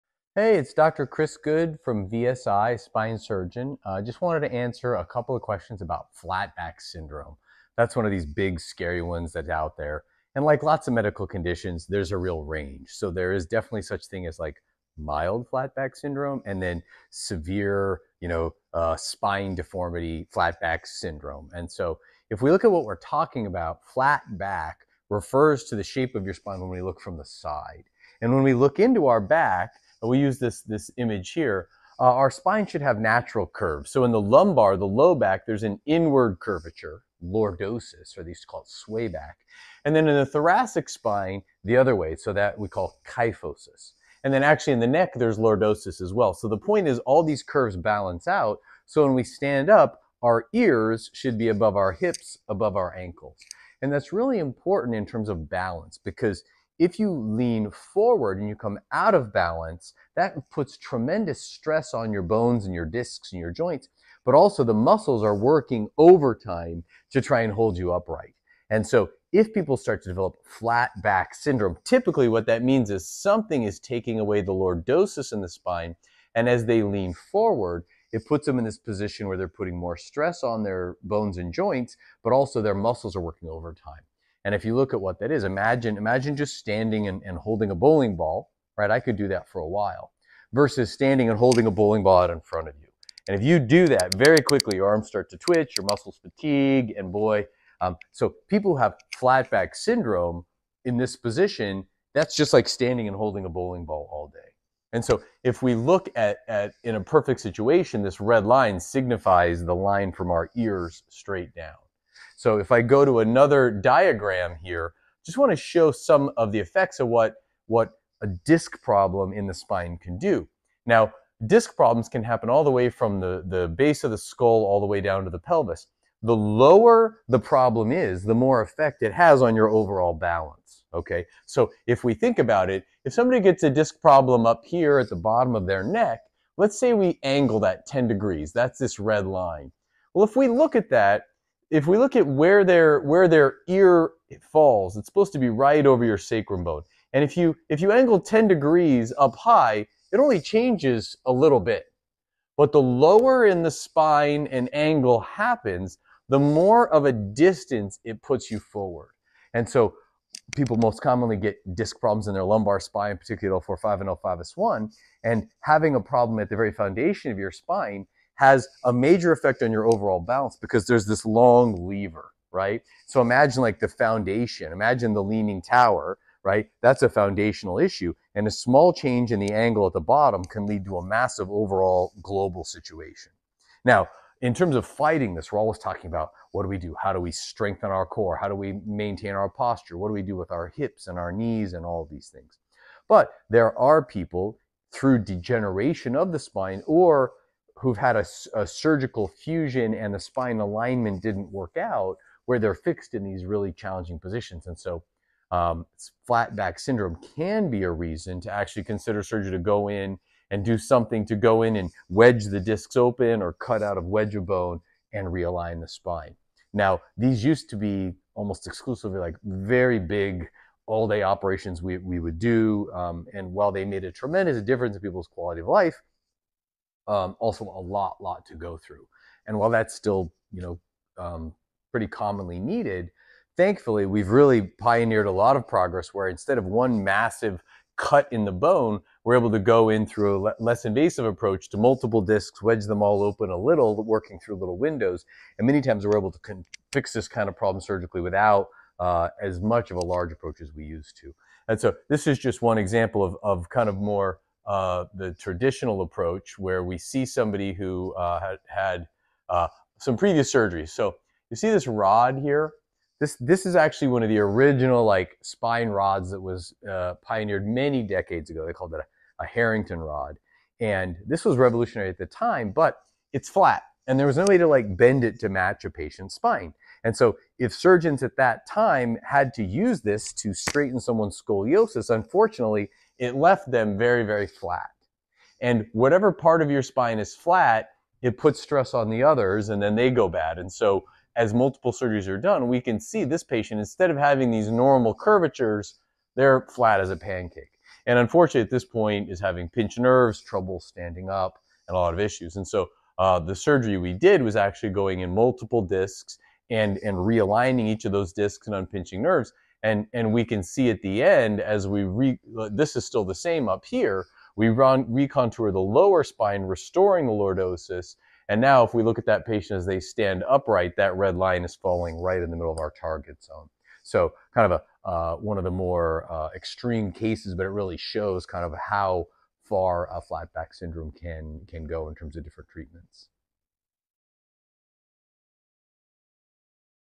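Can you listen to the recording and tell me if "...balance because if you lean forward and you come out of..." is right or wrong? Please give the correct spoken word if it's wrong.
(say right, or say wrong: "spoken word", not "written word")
right.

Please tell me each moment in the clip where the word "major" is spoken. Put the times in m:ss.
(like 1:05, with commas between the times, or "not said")
2:48.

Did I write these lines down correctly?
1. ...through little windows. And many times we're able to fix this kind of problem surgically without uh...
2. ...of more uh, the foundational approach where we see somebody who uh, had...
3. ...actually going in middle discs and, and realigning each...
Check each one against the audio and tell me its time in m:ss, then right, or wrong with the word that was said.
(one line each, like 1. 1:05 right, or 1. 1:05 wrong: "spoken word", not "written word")
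1. 4:04 right
2. 4:13 wrong: "traditional", not "foundational"
3. 5:04 wrong: "multiple", not "middle".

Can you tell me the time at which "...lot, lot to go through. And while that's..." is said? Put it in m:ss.
3:47.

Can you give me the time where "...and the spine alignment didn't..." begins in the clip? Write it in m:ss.
3:19.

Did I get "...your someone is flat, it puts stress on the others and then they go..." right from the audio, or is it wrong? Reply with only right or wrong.
wrong.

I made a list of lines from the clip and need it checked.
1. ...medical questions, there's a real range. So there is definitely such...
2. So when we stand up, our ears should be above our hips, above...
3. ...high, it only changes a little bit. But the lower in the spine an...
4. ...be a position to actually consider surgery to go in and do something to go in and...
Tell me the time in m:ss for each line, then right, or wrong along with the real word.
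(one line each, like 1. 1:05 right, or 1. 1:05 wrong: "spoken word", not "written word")
1. 0:10 wrong: "conditions", not "questions"
2. 0:48 right
3. 2:29 right
4. 3:27 wrong: "reason", not "position".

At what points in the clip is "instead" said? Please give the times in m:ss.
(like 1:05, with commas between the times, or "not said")
3:56, 4:53.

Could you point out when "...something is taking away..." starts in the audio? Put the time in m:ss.
1:13.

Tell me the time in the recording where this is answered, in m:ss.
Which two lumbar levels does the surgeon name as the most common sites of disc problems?
2:43.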